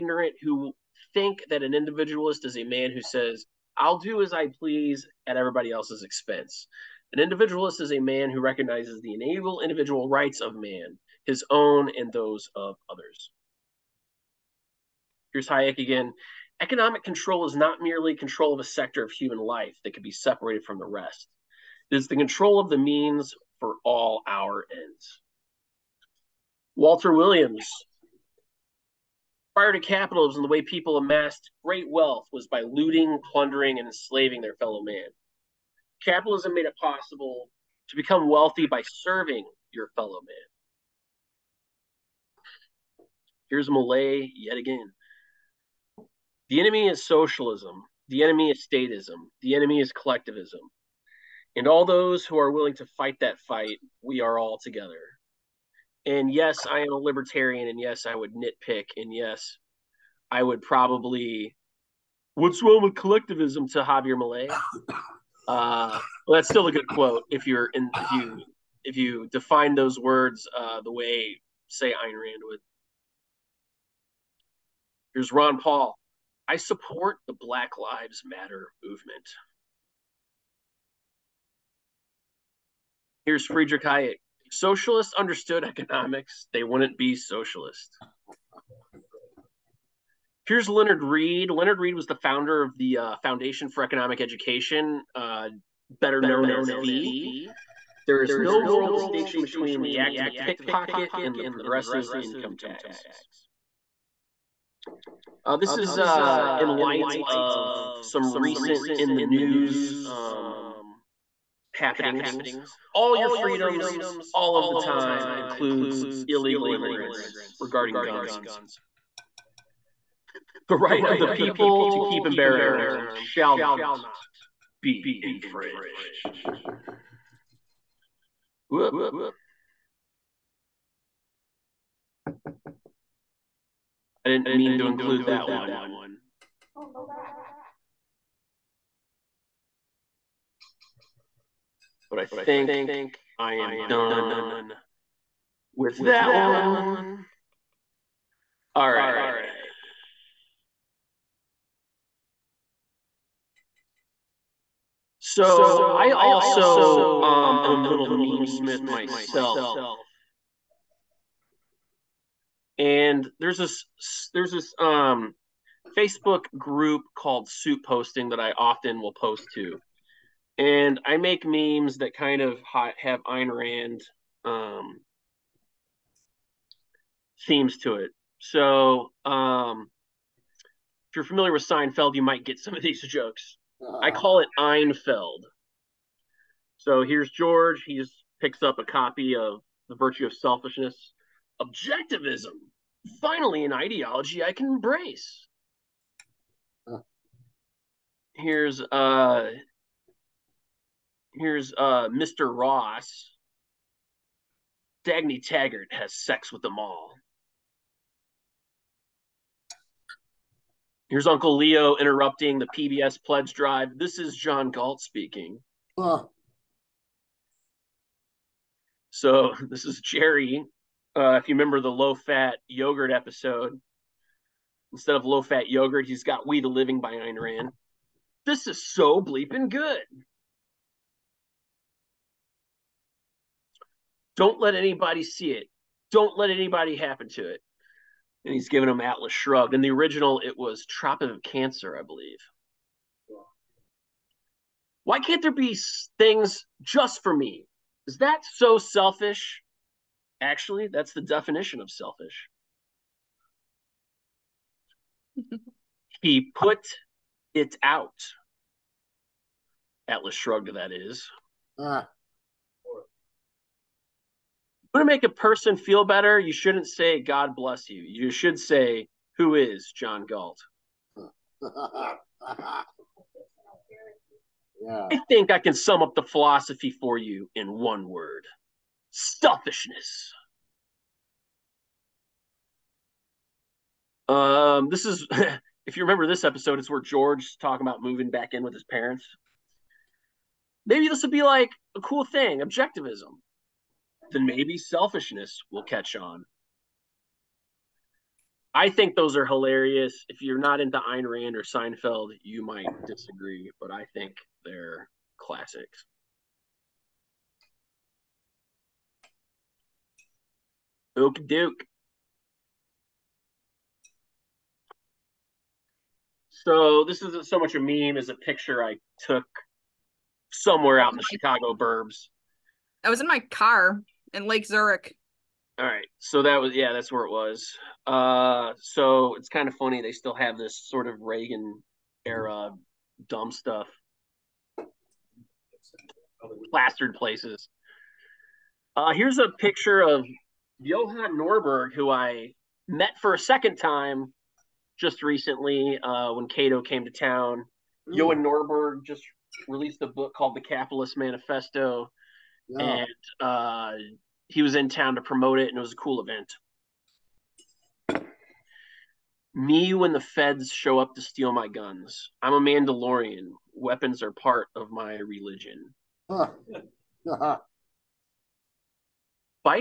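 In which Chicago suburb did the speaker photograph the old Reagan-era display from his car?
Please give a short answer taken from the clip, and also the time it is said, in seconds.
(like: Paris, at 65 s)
Lake Zurich, at 324 s.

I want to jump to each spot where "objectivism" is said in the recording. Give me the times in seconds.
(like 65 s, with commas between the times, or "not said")
191 s, 292 s.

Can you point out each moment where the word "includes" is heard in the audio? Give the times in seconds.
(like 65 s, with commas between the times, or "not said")
115 s, 134 s.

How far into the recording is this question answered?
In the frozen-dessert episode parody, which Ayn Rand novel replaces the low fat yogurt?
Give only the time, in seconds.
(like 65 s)
226 s.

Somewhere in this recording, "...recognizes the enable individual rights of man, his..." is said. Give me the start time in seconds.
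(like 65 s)
8 s.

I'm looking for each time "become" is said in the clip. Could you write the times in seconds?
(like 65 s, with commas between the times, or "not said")
37 s.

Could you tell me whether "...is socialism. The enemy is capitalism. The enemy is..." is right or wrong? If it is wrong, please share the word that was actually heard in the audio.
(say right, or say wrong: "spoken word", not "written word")
wrong: "statism", not "capitalism".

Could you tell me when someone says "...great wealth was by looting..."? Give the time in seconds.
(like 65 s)
31 s.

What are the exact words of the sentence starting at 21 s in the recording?
It is the control of the means for all our ends.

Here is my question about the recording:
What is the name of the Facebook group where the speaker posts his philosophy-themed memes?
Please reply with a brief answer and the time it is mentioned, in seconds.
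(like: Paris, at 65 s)
Soup Posting, at 167 s.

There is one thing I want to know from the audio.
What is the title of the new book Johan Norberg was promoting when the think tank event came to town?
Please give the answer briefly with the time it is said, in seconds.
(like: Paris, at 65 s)
The Capitalist Manifesto, at 350 s.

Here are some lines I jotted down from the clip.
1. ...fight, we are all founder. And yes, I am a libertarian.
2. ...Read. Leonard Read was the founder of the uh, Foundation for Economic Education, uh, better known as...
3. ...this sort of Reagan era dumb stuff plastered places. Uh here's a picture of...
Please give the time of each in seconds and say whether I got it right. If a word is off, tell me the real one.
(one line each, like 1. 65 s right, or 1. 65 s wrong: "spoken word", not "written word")
1. 53 s wrong: "together", not "founder"
2. 91 s right
3. 330 s right.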